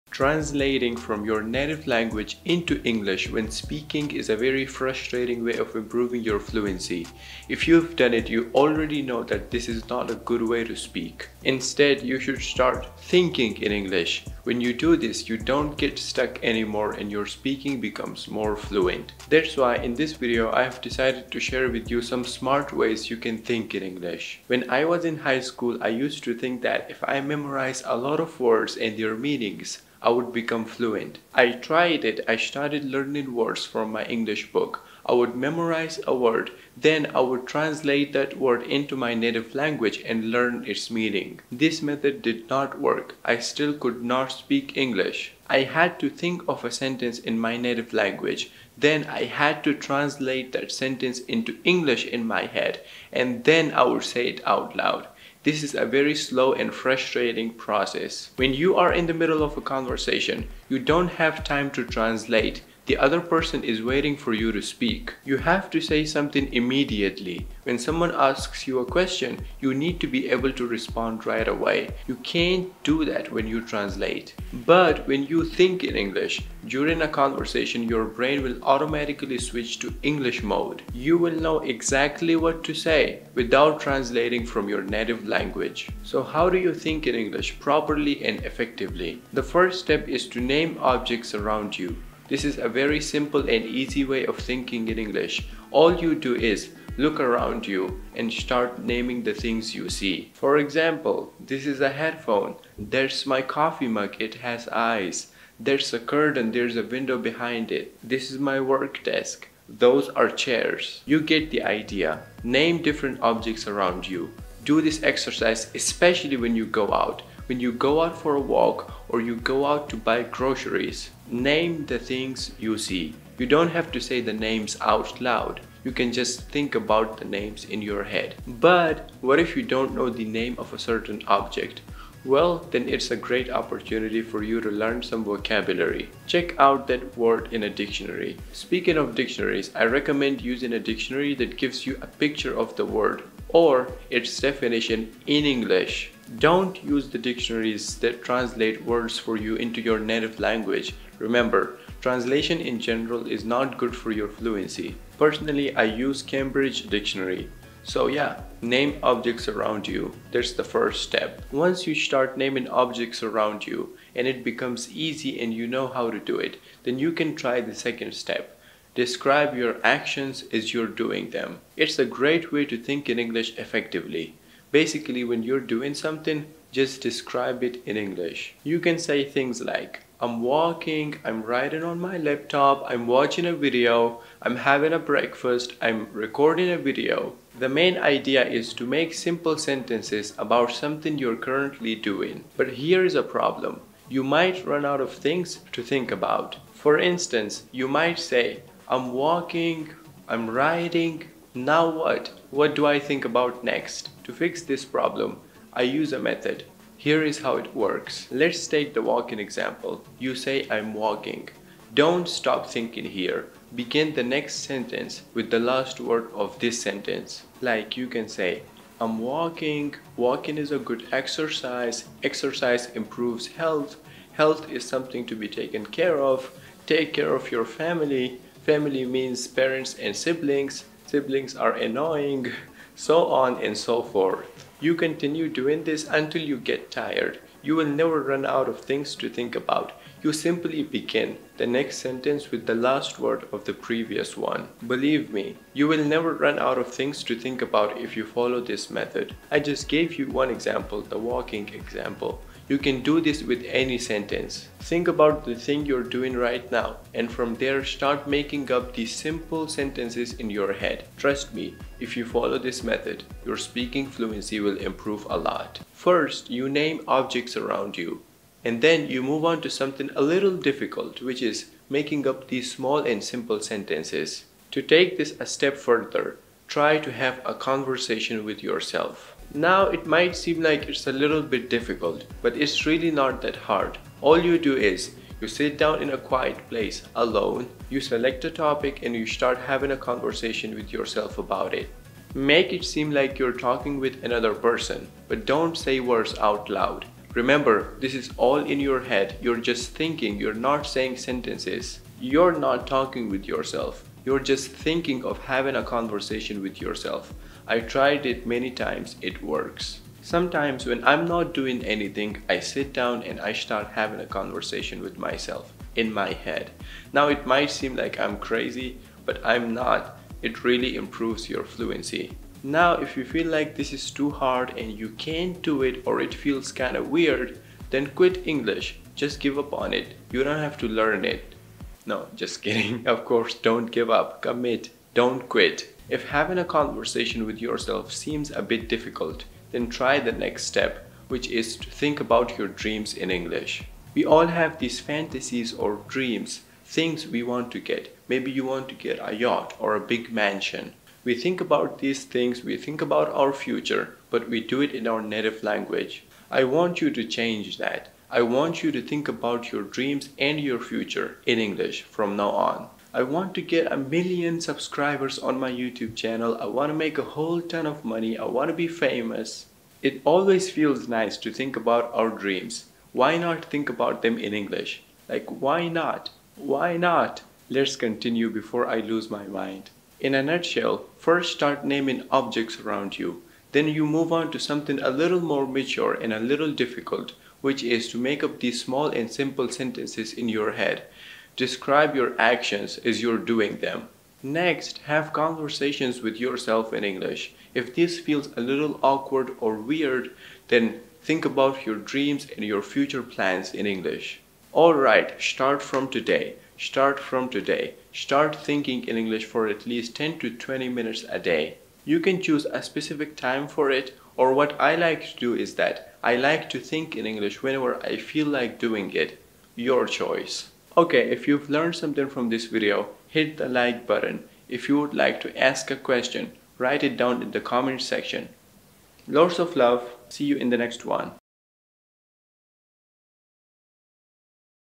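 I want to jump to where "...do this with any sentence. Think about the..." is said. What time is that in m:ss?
4:13.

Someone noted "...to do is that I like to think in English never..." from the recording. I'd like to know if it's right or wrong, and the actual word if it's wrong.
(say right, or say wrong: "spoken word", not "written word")
wrong: "whenever", not "never".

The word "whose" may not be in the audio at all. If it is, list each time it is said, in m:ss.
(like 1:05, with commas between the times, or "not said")
not said.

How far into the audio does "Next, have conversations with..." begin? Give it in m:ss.
6:34.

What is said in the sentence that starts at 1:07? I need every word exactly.
When someone asks you a question, you need to be able to respond right away.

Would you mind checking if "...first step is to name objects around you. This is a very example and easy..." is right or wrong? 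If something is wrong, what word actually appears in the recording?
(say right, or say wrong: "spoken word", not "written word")
wrong: "simple", not "example".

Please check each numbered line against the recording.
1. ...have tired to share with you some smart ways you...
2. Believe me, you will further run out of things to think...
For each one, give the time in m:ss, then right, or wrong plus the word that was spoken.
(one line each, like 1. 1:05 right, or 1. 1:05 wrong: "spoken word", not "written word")
1. 0:20 wrong: "decided", not "tired"
2. 4:04 wrong: "never", not "further".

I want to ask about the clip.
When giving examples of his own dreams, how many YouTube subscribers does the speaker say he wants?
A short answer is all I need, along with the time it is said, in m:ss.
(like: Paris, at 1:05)
1 million, at 6:03.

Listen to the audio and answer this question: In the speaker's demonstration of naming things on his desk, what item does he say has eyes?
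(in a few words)
coffee mug.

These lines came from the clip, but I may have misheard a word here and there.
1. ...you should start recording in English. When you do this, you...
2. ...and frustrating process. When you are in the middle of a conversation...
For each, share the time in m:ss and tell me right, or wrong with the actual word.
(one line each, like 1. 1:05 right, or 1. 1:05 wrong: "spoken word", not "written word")
1. 0:12 wrong: "thinking", not "recording"
2. 0:56 right.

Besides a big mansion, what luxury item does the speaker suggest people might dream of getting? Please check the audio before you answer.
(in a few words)
a yacht.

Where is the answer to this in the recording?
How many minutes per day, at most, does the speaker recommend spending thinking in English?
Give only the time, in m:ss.
6:50.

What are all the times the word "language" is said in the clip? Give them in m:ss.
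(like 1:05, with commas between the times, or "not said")
0:01, 0:39, 0:47, 1:25, 2:30, 5:55.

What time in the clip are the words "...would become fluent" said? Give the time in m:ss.
0:30.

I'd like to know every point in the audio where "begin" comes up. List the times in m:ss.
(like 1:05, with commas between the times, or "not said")
3:33, 4:00.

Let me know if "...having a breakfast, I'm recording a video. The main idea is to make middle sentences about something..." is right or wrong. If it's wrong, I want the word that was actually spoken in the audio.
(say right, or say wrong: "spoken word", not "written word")
wrong: "simple", not "middle".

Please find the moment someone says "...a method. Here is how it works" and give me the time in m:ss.
3:26.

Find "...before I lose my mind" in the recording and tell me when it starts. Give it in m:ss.
6:18.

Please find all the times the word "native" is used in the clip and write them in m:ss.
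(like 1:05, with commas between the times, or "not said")
0:01, 0:39, 0:47, 1:24, 2:29, 5:55.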